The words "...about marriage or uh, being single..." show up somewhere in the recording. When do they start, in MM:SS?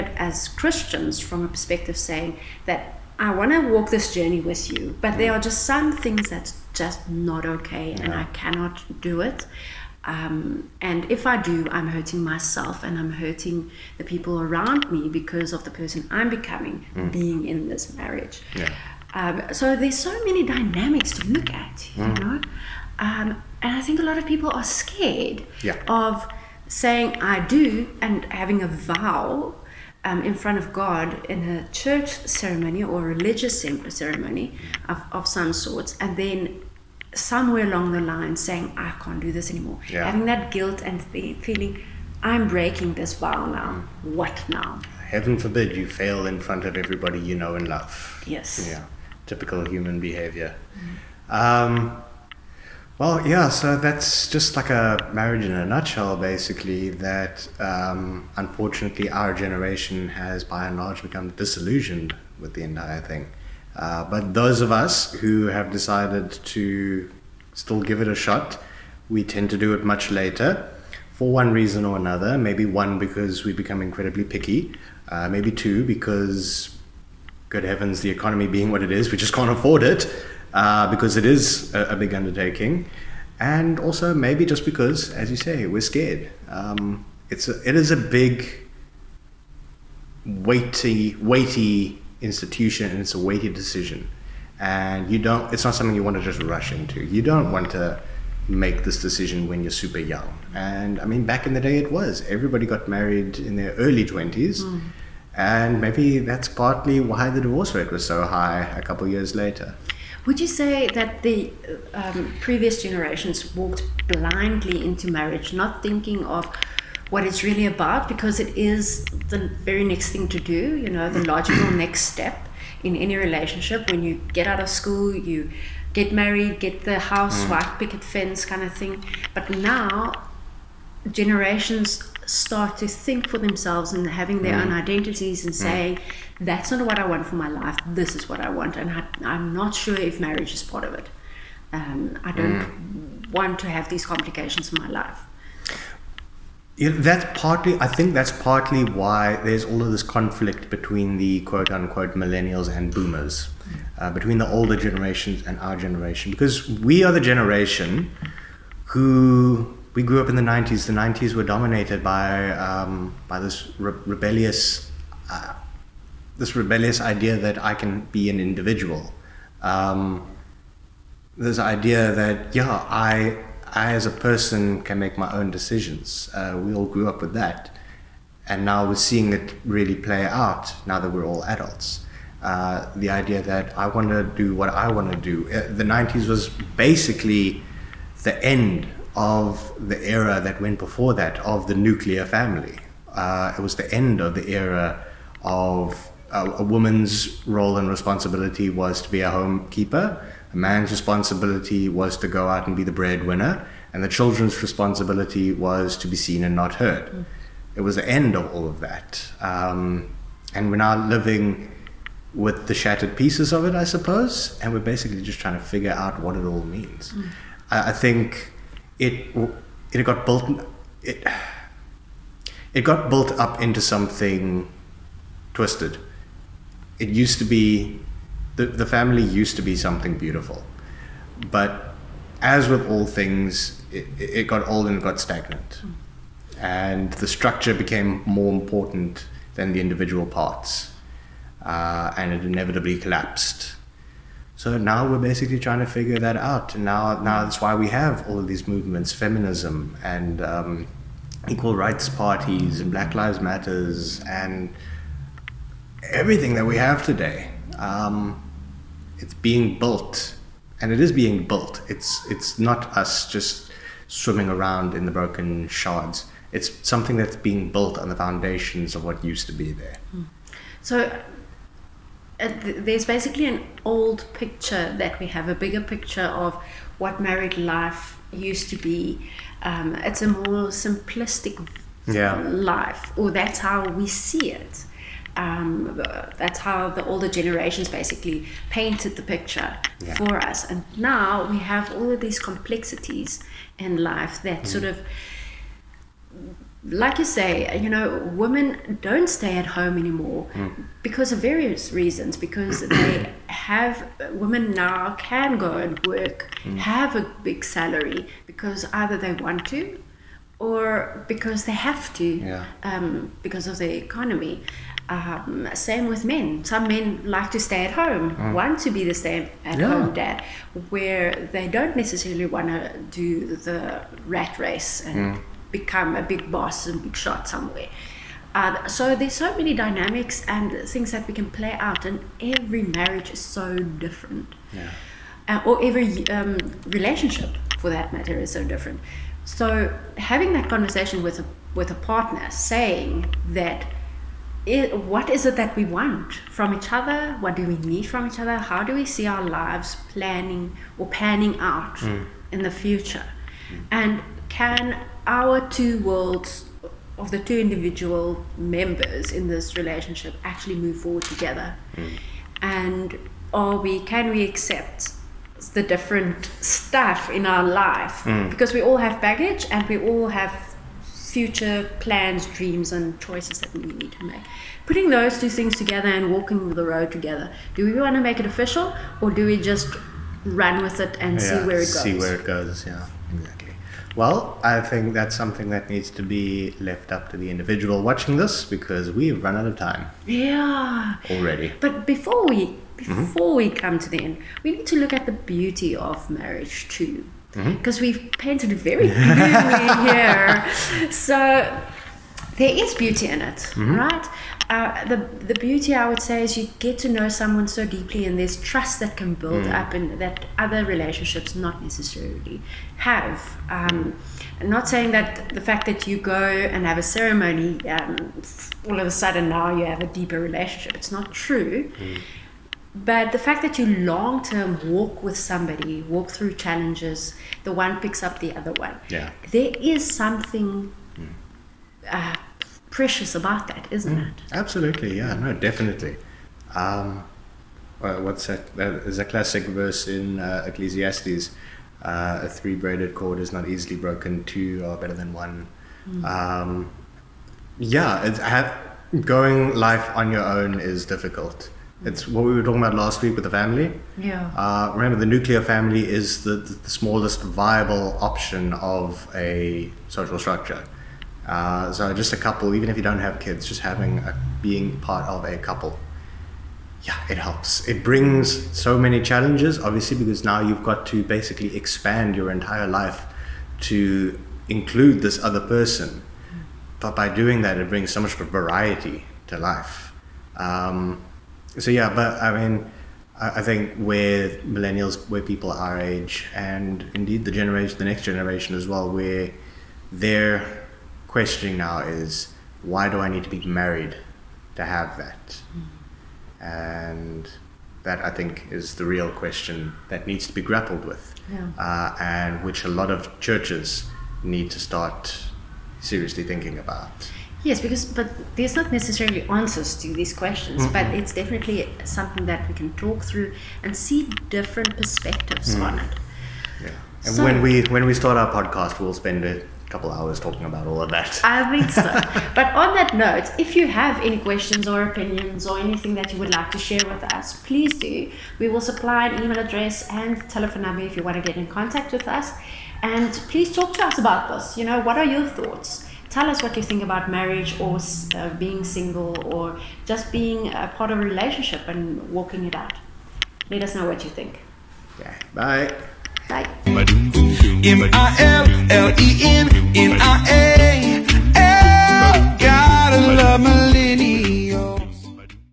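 08:57.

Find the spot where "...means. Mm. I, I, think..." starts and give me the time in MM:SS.
03:36.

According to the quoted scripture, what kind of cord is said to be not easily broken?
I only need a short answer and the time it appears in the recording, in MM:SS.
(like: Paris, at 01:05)
three-braided cord, at 07:22.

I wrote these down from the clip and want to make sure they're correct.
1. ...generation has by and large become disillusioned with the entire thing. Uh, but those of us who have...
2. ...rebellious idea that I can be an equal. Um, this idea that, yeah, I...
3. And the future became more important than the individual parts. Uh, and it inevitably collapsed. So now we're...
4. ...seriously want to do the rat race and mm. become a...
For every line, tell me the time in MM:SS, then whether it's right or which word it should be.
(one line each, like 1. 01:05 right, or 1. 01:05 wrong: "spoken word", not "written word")
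1. 00:59 right
2. 02:46 wrong: "individual", not "equal"
3. 03:56 wrong: "structure", not "future"
4. 05:21 wrong: "necessarily", not "seriously".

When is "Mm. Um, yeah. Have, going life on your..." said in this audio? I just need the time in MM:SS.
07:26.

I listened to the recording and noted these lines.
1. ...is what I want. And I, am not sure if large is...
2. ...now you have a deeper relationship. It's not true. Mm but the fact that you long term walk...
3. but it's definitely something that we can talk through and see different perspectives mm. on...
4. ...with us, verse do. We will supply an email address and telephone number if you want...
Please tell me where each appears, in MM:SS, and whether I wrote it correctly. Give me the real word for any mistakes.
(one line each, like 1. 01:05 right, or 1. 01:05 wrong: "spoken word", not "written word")
1. 02:18 wrong: "marriage", not "large"
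2. 06:59 right
3. 08:30 right
4. 08:47 wrong: "please", not "verse".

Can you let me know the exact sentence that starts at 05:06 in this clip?
have a big salary because either they want to or because they have to yeah.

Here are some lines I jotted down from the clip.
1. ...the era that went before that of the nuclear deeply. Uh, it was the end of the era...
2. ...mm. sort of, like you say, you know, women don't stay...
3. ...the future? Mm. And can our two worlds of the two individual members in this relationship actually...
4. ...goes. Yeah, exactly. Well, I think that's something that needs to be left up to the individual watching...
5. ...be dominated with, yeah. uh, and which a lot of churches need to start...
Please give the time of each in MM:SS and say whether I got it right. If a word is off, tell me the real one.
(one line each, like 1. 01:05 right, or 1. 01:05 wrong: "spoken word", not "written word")
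1. 03:09 wrong: "family", not "deeply"
2. 04:54 right
3. 05:52 right
4. 06:22 right
5. 08:20 wrong: "grappled", not "dominated".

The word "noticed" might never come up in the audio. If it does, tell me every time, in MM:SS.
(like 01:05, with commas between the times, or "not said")
not said.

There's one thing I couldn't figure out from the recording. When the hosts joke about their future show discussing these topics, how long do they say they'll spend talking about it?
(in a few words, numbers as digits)
a couple hours.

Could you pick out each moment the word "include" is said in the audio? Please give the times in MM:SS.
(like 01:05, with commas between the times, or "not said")
07:54.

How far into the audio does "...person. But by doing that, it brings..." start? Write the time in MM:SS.
07:55.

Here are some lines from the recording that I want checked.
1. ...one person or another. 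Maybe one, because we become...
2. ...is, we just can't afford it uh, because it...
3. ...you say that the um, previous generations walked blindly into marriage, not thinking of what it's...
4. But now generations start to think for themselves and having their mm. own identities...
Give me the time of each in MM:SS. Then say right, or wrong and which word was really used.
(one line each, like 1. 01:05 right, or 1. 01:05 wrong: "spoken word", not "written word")
1. 01:11 wrong: "reason", not "person"
2. 01:18 right
3. 01:50 right
4. 02:09 right.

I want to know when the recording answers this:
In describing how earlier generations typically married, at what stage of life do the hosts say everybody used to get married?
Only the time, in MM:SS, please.
01:43.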